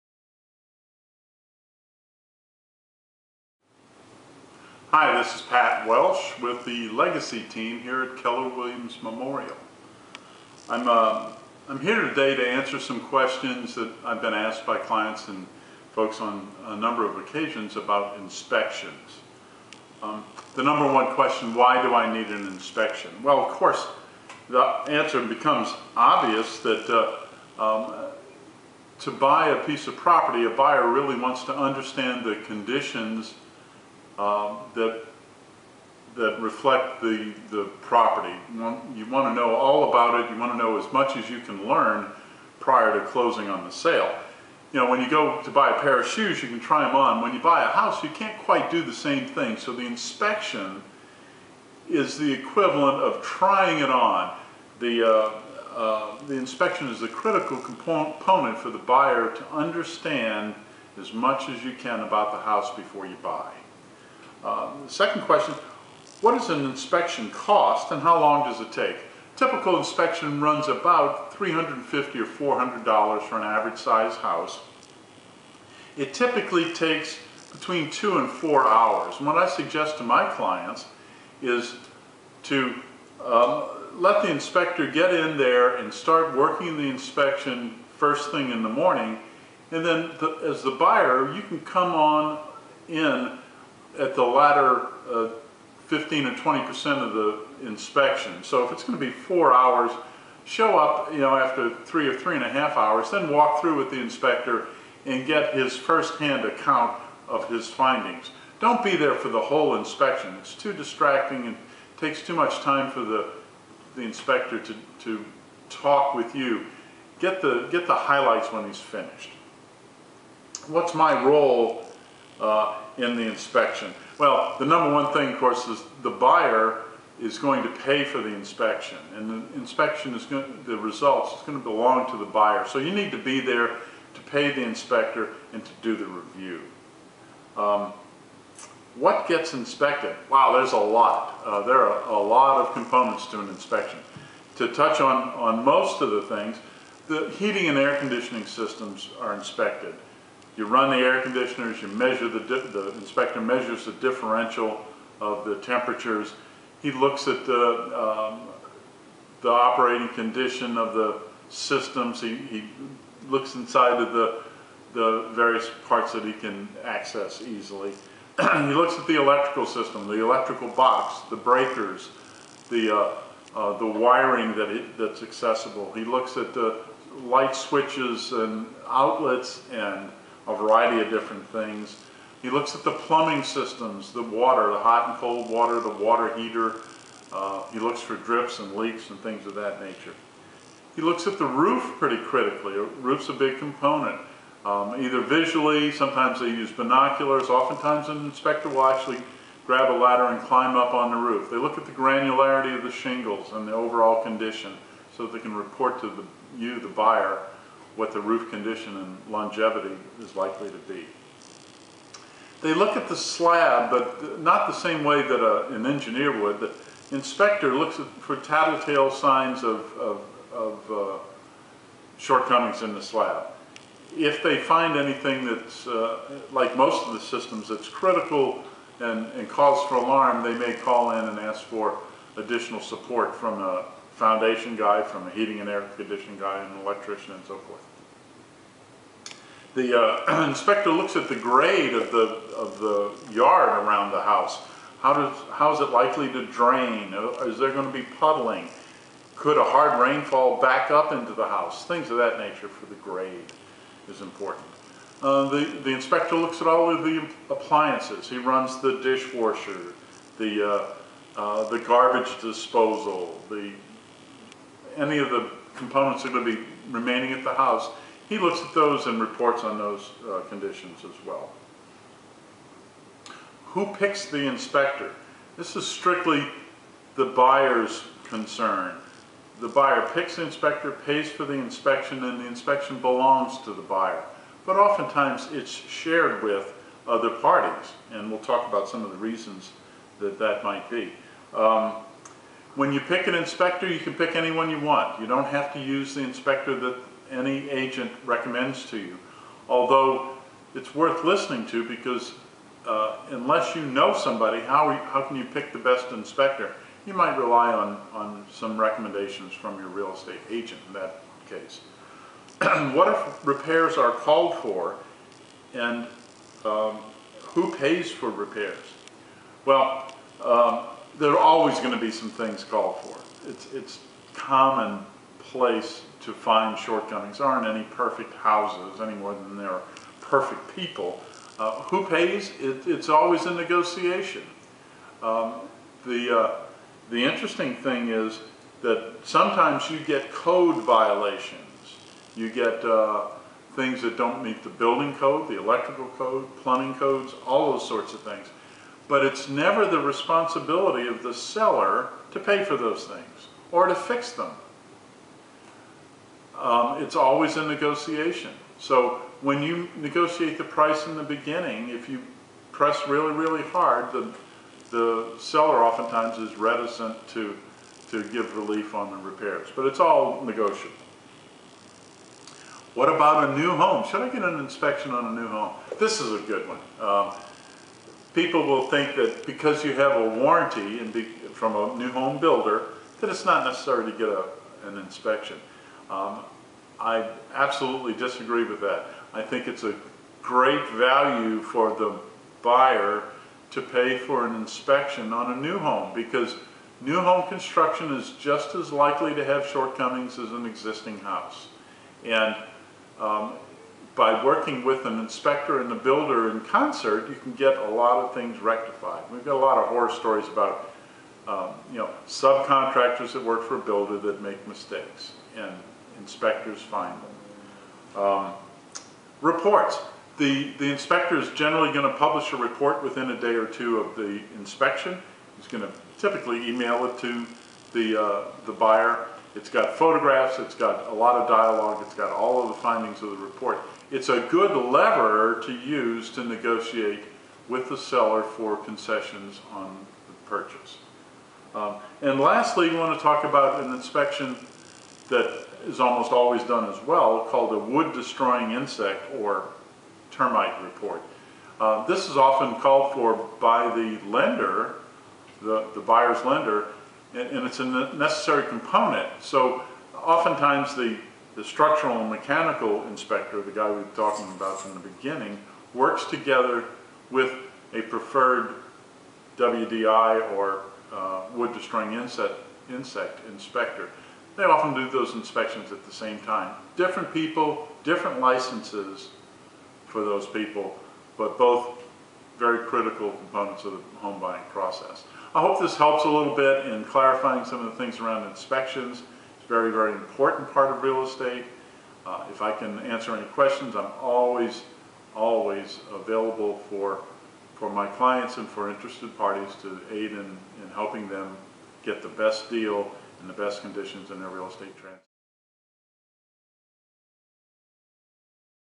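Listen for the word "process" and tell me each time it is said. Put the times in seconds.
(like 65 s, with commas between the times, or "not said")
484 s.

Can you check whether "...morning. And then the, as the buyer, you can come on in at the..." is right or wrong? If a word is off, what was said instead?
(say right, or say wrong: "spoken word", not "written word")
right.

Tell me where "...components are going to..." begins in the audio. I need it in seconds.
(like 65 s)
265 s.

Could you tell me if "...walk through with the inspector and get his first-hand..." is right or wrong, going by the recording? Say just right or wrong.
right.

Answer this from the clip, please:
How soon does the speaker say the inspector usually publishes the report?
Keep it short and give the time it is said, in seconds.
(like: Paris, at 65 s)
A day or two, at 423 s.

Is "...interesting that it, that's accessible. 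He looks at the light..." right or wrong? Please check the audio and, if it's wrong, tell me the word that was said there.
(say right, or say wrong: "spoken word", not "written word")
wrong: "wiring", not "interesting".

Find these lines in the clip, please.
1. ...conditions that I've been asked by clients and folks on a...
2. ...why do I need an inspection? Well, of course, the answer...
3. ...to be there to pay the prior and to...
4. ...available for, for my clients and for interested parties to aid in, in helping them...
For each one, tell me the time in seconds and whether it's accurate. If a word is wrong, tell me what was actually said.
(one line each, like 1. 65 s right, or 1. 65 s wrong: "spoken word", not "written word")
1. 12 s wrong: "questions", not "conditions"
2. 21 s right
3. 133 s wrong: "inspector", not "prior"
4. 496 s right.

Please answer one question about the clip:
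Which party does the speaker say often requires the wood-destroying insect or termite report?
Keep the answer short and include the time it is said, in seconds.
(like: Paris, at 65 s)
The buyer's lender, at 455 s.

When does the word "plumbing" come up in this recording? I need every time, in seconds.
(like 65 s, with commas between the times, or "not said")
182 s, 346 s.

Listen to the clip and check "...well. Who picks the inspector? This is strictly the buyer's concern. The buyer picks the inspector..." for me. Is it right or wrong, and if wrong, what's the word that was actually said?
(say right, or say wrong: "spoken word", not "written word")
right.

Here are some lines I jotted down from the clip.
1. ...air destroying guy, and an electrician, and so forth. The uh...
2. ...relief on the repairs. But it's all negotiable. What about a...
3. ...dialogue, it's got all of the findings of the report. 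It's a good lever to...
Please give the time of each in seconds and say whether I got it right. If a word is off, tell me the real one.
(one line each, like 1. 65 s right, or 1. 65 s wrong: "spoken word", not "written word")
1. 235 s wrong: "conditioning", not "destroying"
2. 368 s right
3. 431 s right.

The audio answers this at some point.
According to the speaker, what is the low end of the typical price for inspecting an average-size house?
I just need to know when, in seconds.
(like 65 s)
71 s.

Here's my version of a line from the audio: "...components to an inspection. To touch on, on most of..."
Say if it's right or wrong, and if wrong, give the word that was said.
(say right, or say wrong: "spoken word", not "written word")
right.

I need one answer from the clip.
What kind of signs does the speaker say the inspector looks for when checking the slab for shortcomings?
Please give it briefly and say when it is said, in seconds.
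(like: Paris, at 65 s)
Tattletale signs, at 218 s.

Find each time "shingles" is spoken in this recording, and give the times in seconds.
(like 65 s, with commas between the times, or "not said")
202 s.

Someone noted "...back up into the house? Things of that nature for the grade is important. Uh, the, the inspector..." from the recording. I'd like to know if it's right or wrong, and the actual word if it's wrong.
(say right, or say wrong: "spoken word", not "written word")
right.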